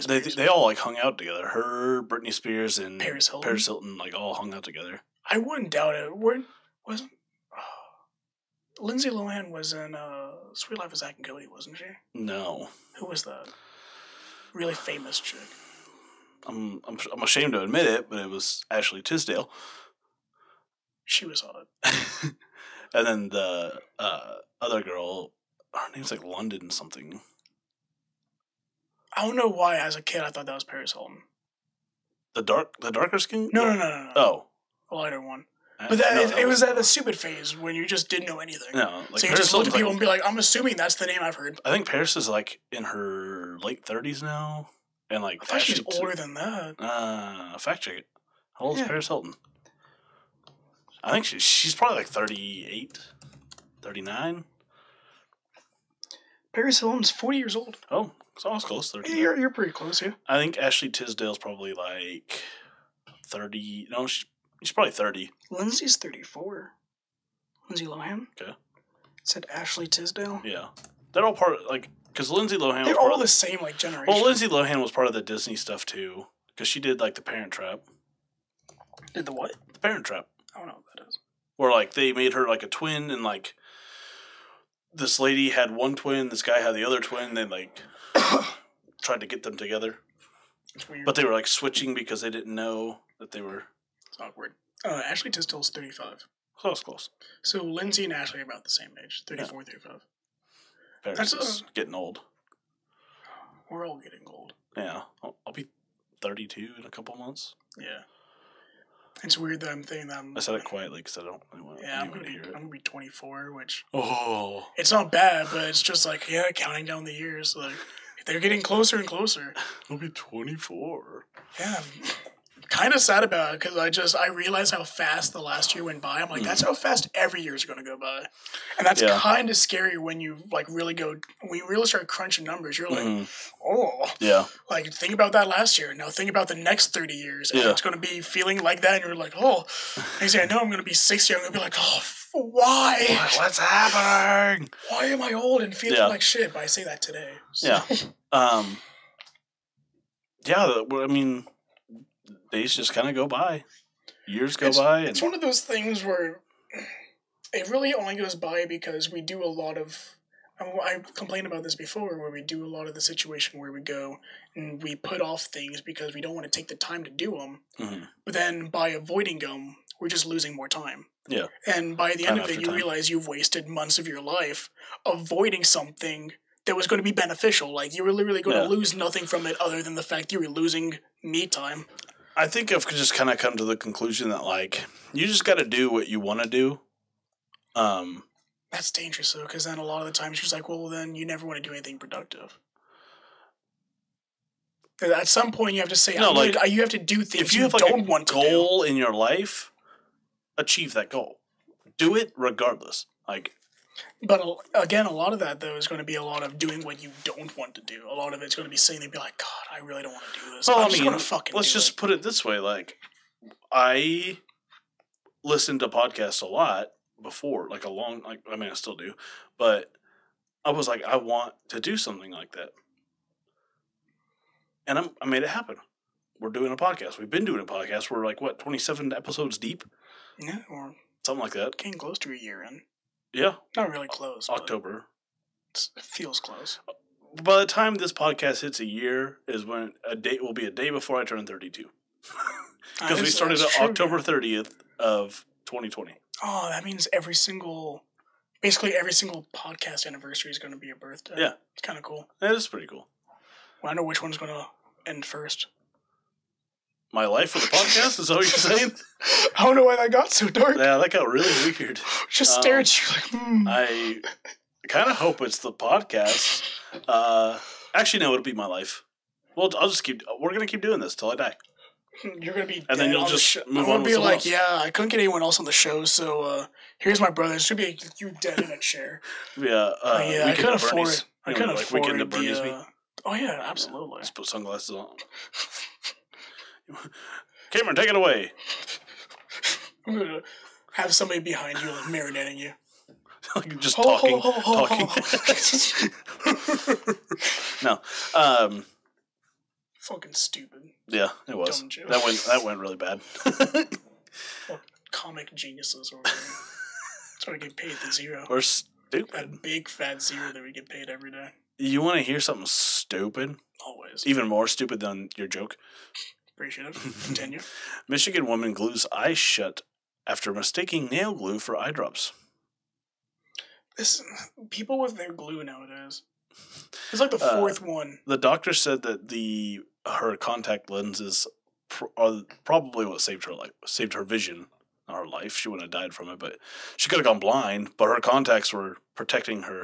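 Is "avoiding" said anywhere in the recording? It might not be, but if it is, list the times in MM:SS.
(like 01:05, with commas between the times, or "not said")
02:48, 02:55.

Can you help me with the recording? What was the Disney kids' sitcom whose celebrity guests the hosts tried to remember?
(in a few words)
Suite Life of Zack and Cody.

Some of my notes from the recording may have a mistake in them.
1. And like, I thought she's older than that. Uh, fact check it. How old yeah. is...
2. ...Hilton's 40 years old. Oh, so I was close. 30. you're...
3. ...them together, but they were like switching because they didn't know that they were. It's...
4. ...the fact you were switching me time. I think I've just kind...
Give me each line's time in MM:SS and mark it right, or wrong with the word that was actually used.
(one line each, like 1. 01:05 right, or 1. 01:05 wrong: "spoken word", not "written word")
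1. 00:45 right
2. 00:56 right
3. 01:29 right
4. 02:59 wrong: "losing", not "switching".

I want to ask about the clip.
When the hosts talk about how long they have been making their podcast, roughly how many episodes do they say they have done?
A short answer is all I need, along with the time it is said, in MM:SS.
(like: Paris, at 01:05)
27, at 03:48.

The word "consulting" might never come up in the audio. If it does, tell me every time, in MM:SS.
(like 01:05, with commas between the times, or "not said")
not said.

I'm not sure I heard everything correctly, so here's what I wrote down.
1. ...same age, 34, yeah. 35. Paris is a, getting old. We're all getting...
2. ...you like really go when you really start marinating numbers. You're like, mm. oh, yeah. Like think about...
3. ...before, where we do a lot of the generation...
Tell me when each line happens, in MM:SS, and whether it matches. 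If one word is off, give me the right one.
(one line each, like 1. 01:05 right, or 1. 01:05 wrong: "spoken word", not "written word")
1. 01:38 right
2. 02:10 wrong: "crunching", not "marinating"
3. 02:41 wrong: "situation", not "generation".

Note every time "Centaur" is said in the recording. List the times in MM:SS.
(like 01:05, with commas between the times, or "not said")
not said.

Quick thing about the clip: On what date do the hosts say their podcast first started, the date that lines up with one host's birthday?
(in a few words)
October 30, 2020.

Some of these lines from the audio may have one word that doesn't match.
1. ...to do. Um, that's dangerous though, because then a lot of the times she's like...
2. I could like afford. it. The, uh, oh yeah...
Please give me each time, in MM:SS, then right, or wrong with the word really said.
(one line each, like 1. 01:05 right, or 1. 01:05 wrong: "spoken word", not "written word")
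1. 03:06 right
2. 04:41 right.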